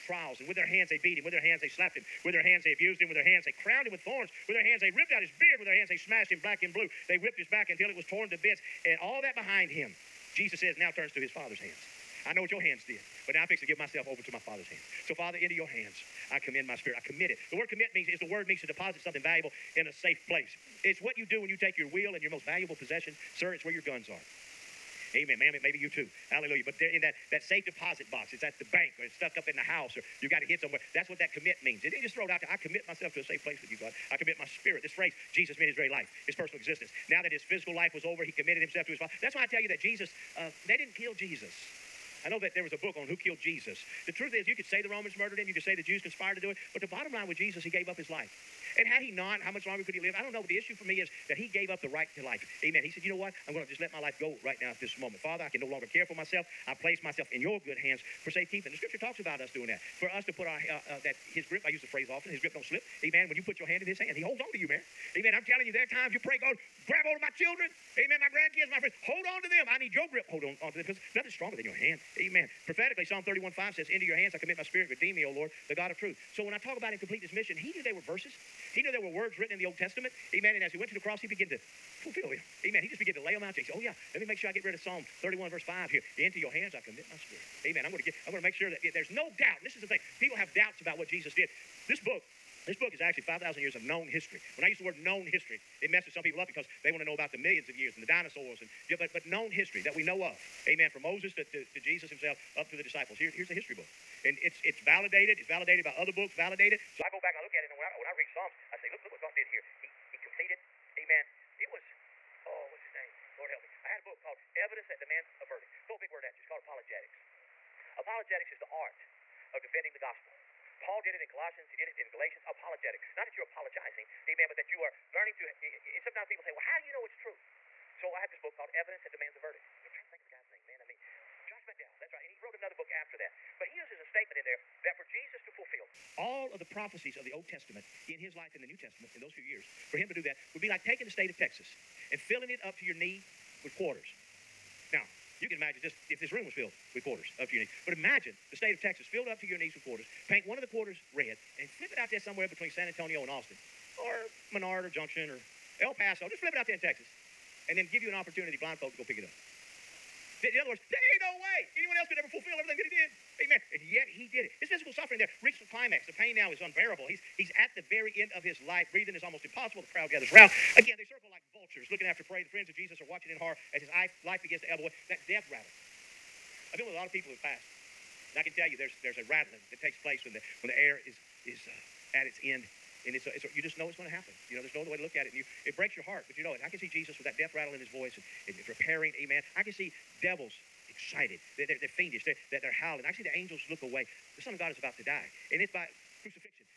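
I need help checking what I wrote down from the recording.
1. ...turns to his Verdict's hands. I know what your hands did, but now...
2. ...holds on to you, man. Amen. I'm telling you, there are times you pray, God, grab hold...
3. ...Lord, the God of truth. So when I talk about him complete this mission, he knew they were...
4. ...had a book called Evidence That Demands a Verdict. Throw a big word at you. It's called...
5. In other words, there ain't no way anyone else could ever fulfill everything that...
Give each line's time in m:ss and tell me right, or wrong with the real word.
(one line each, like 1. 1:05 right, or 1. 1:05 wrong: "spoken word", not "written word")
1. 0:10 wrong: "Father", not "Verdict"
2. 1:04 right
3. 1:15 right
4. 1:53 right
5. 2:40 right.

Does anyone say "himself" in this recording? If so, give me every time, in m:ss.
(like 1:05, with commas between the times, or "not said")
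0:38, 1:42.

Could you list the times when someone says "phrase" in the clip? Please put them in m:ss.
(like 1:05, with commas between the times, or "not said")
0:34, 1:01.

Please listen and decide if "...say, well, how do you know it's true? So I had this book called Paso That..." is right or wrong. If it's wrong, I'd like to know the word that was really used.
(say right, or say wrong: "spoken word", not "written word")
wrong: "Evidence", not "Paso".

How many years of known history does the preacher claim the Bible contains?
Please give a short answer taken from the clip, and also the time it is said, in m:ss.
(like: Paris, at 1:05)
5,000, at 1:33.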